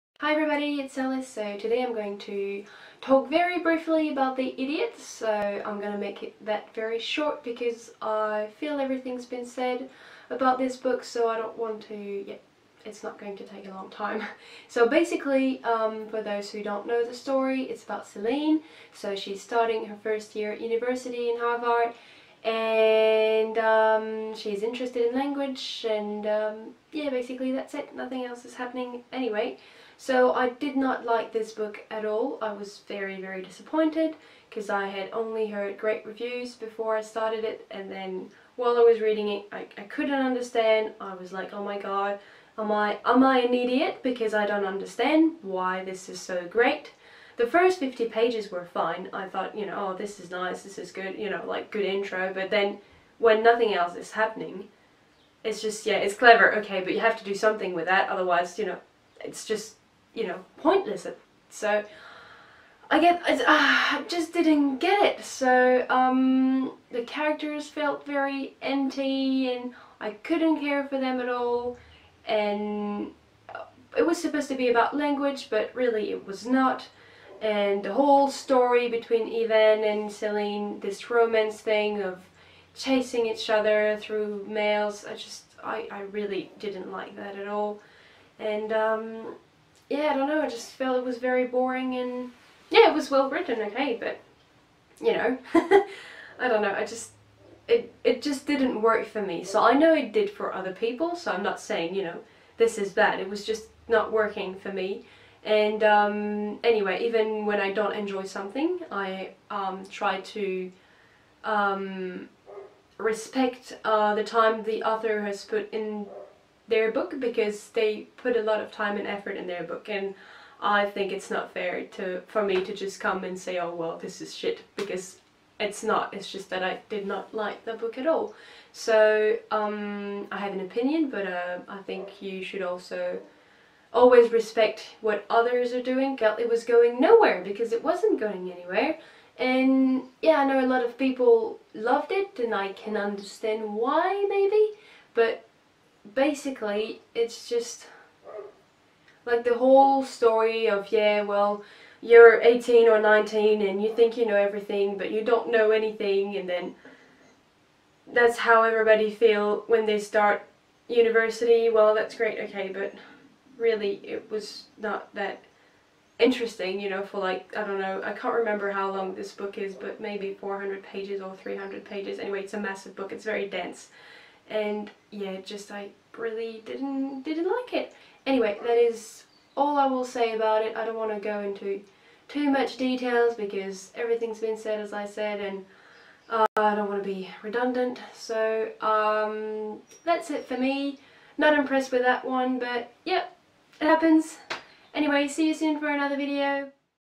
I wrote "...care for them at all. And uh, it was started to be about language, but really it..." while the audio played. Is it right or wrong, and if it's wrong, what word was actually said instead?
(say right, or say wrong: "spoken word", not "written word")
wrong: "supposed", not "started".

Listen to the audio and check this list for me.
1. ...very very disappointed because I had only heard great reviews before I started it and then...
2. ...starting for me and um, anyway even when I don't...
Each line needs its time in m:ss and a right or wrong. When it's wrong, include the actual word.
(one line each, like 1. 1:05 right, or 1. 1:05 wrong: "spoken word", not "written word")
1. 0:32 right
2. 1:44 wrong: "working", not "starting".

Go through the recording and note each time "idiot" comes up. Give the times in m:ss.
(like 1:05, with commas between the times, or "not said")
0:04, 0:43.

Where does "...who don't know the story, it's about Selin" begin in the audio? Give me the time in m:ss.
0:16.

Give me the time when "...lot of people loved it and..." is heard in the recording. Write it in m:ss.
2:20.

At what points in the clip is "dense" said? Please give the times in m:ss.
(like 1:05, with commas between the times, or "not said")
2:53.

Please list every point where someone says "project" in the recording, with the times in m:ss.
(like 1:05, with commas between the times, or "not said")
not said.